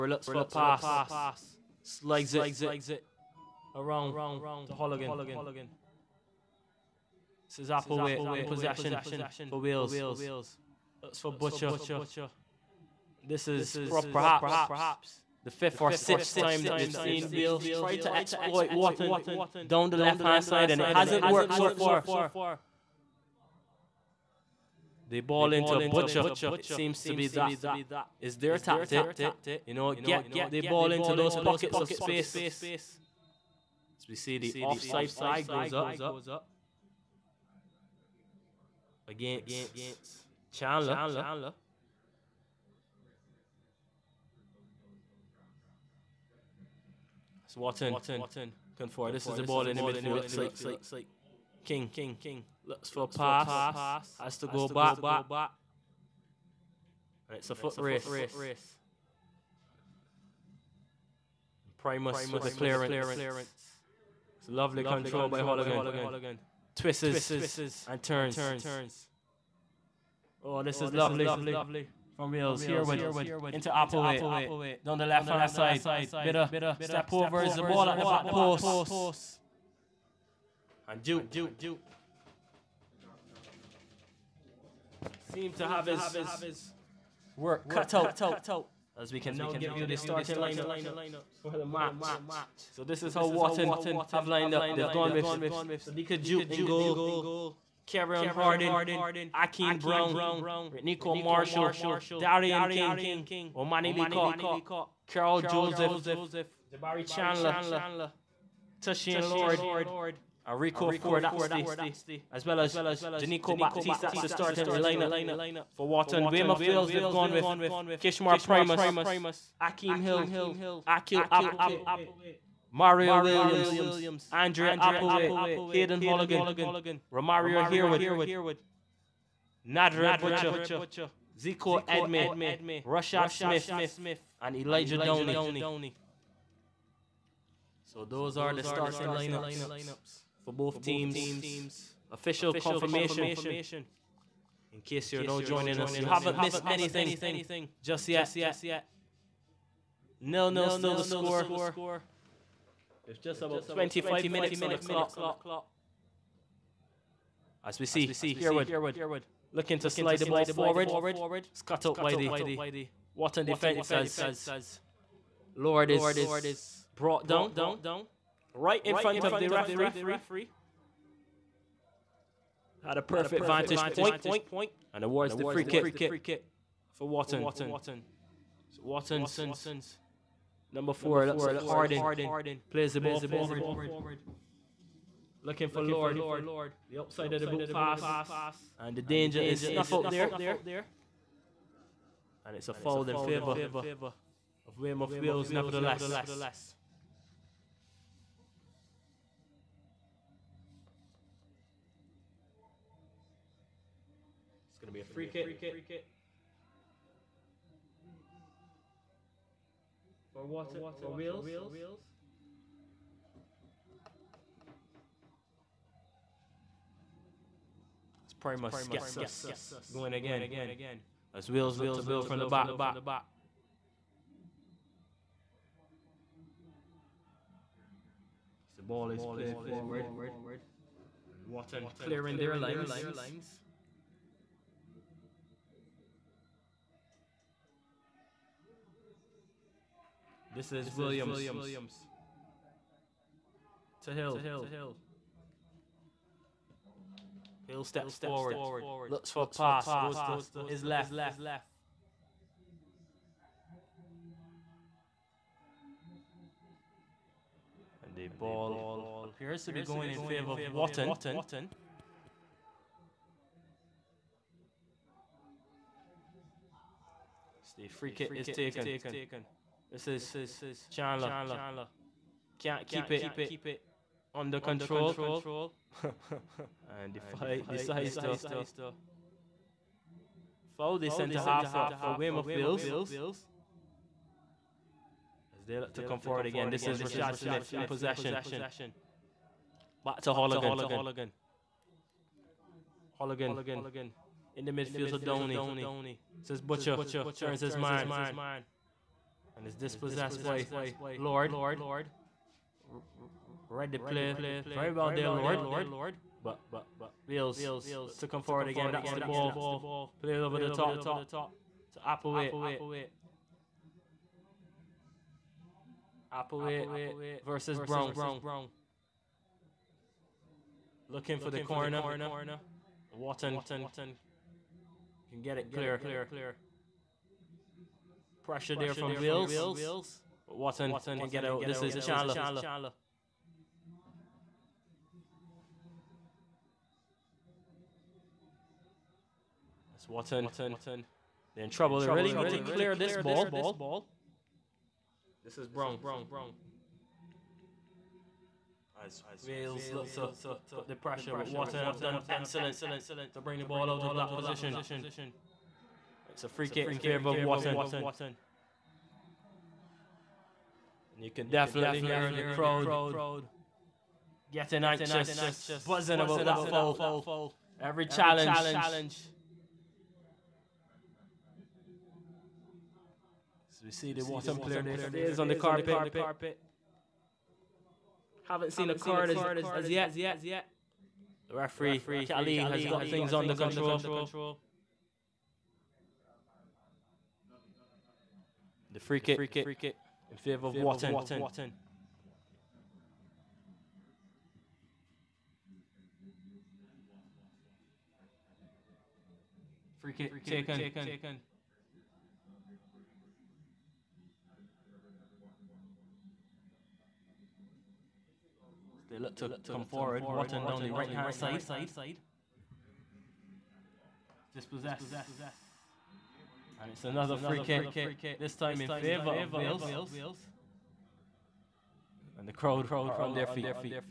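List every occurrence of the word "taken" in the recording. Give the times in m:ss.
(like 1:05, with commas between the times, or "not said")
4:28, 6:40.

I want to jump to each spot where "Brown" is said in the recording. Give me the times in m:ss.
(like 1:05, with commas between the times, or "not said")
1:39, 5:17, 5:45.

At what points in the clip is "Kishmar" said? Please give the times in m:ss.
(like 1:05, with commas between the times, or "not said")
1:57.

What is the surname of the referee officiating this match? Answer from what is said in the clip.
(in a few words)
Kelly.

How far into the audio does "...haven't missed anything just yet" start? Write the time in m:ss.
2:26.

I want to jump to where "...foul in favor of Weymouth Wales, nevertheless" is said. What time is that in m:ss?
3:12.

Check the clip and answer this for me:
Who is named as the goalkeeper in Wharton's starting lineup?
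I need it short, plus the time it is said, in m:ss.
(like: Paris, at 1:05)
Sadiqa Jute, at 1:35.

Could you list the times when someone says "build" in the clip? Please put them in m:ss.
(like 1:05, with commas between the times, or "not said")
3:42.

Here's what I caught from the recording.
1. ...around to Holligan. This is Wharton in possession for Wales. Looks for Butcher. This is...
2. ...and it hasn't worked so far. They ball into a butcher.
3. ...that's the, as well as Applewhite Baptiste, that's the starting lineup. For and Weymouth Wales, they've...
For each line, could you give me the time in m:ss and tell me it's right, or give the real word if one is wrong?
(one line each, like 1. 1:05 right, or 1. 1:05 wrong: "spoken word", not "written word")
1. 0:03 wrong: "Applewhite", not "Wharton"
2. 0:20 right
3. 1:51 wrong: "Jenico", not "Applewhite".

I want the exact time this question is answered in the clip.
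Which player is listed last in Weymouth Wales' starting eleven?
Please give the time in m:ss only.
2:14.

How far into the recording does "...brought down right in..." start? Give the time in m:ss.
2:46.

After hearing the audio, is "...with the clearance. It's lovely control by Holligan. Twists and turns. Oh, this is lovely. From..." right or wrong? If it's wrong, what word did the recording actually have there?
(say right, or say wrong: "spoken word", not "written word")
right.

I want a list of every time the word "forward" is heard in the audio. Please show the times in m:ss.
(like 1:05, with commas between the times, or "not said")
2:40, 3:03, 3:49, 4:08, 4:46, 5:08, 6:49.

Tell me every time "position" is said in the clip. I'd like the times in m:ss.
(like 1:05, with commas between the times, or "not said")
5:54.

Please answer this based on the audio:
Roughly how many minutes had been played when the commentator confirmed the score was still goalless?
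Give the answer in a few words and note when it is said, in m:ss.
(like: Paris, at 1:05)
25, at 2:33.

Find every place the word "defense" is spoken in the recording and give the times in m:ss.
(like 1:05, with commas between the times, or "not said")
2:43.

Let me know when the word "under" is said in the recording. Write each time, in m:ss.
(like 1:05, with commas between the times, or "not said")
4:34, 6:23.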